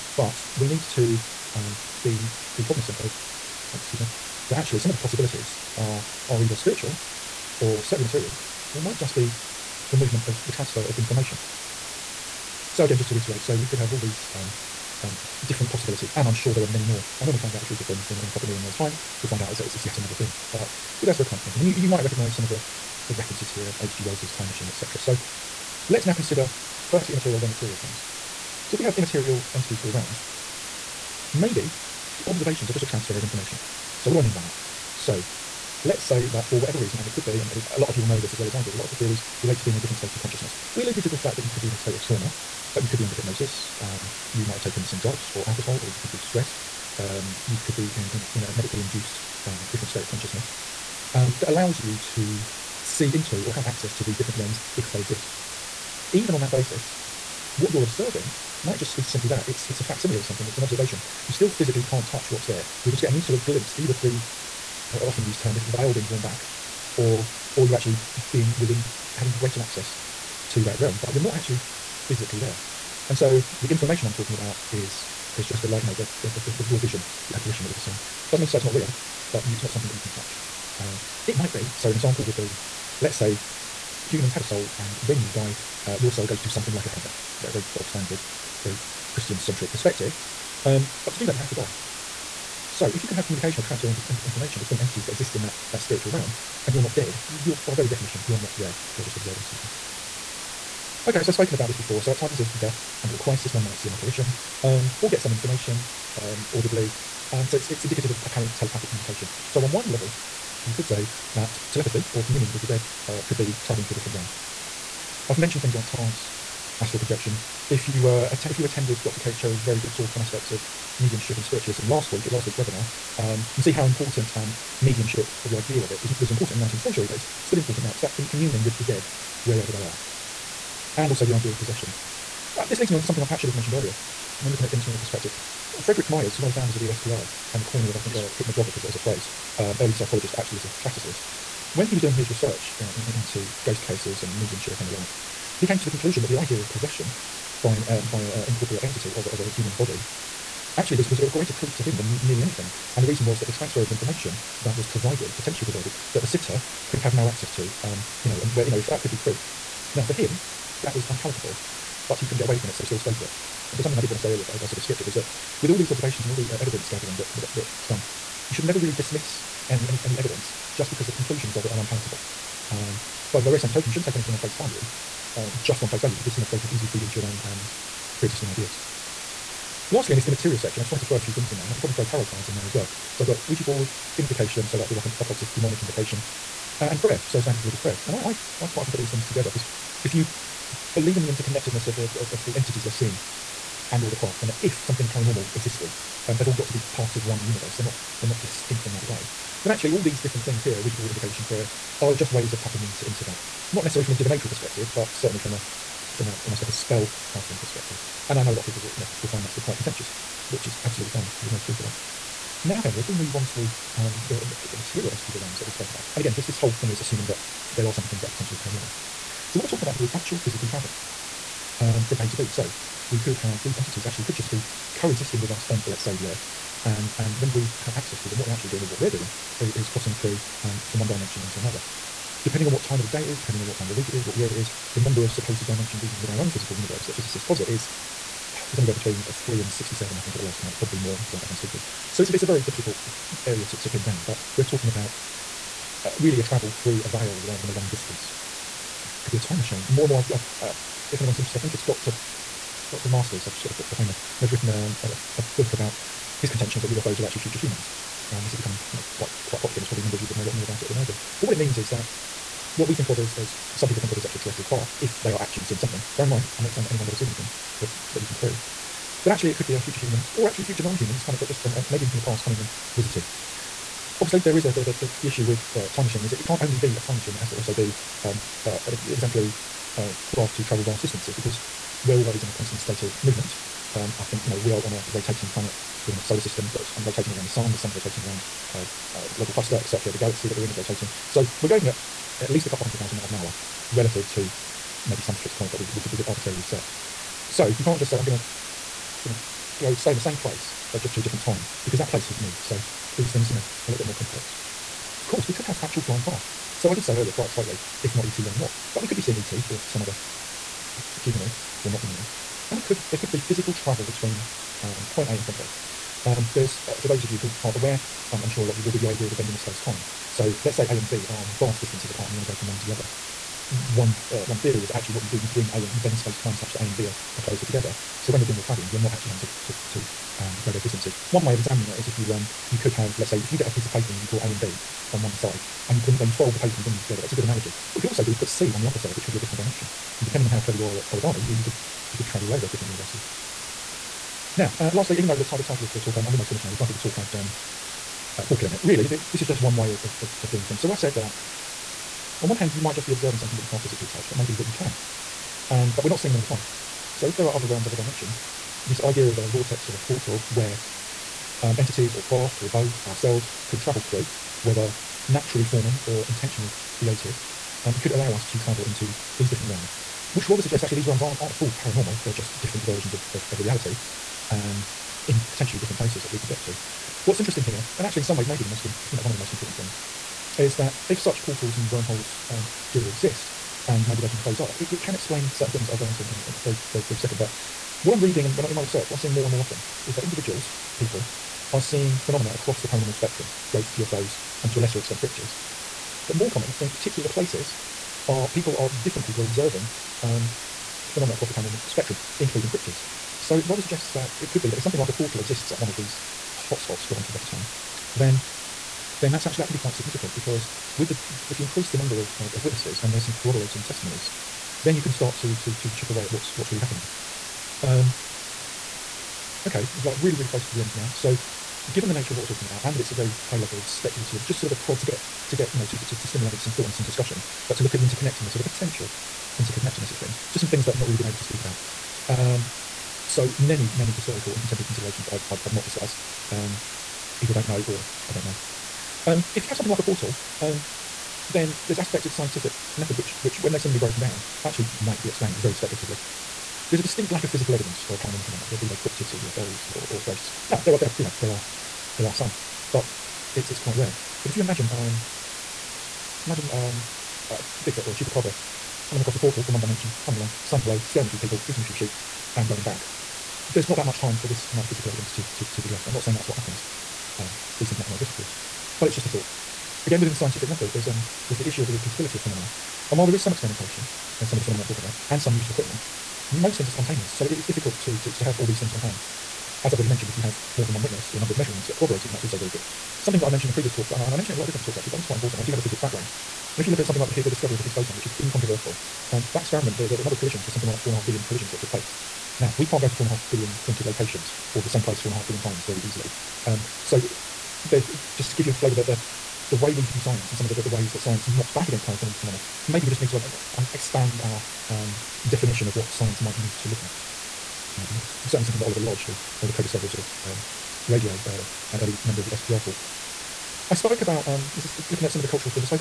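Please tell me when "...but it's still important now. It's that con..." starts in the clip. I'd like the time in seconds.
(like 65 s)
127 s.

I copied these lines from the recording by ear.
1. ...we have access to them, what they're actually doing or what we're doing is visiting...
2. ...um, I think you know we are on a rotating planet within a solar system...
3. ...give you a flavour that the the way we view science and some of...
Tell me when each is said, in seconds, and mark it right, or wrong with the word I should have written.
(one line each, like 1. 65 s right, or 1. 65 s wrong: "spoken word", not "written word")
1. 227 s wrong: "crossing", not "visiting"
2. 283 s right
3. 498 s right.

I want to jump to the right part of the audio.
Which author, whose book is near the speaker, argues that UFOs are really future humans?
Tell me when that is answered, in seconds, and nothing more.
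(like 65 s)
252 s.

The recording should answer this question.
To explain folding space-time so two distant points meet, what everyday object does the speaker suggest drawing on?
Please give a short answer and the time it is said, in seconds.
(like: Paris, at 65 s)
A piece of paper, at 333 s.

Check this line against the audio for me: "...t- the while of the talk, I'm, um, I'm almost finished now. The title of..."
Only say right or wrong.
wrong.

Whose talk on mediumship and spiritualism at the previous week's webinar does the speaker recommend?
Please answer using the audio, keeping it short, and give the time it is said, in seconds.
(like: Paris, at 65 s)
Dr. Kate Cheryl, at 119 s.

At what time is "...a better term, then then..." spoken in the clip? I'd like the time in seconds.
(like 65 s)
407 s.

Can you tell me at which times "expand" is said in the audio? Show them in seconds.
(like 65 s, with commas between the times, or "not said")
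503 s.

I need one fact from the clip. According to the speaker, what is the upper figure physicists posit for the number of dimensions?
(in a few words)
67.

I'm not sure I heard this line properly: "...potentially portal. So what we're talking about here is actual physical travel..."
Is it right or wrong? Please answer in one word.
wrong.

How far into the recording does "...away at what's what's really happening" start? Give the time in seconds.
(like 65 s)
416 s.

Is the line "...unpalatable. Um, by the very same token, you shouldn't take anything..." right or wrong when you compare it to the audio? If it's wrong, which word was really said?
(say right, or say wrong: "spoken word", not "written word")
right.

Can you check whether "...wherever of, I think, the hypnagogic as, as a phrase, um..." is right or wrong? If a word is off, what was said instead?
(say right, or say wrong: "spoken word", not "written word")
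wrong: "coiner", not "wherever".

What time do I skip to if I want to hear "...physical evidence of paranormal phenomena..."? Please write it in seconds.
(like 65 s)
447 s.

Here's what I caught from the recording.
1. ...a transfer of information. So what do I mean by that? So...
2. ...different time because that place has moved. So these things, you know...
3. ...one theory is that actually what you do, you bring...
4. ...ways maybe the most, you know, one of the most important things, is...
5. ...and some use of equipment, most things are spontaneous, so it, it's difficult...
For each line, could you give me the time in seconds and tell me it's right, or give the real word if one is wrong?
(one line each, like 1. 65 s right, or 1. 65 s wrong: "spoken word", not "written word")
1. 32 s right
2. 301 s right
3. 324 s right
4. 378 s right
5. 475 s right.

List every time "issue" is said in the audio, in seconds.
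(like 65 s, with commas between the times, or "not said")
275 s, 471 s.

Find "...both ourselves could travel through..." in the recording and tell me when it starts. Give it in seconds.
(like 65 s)
362 s.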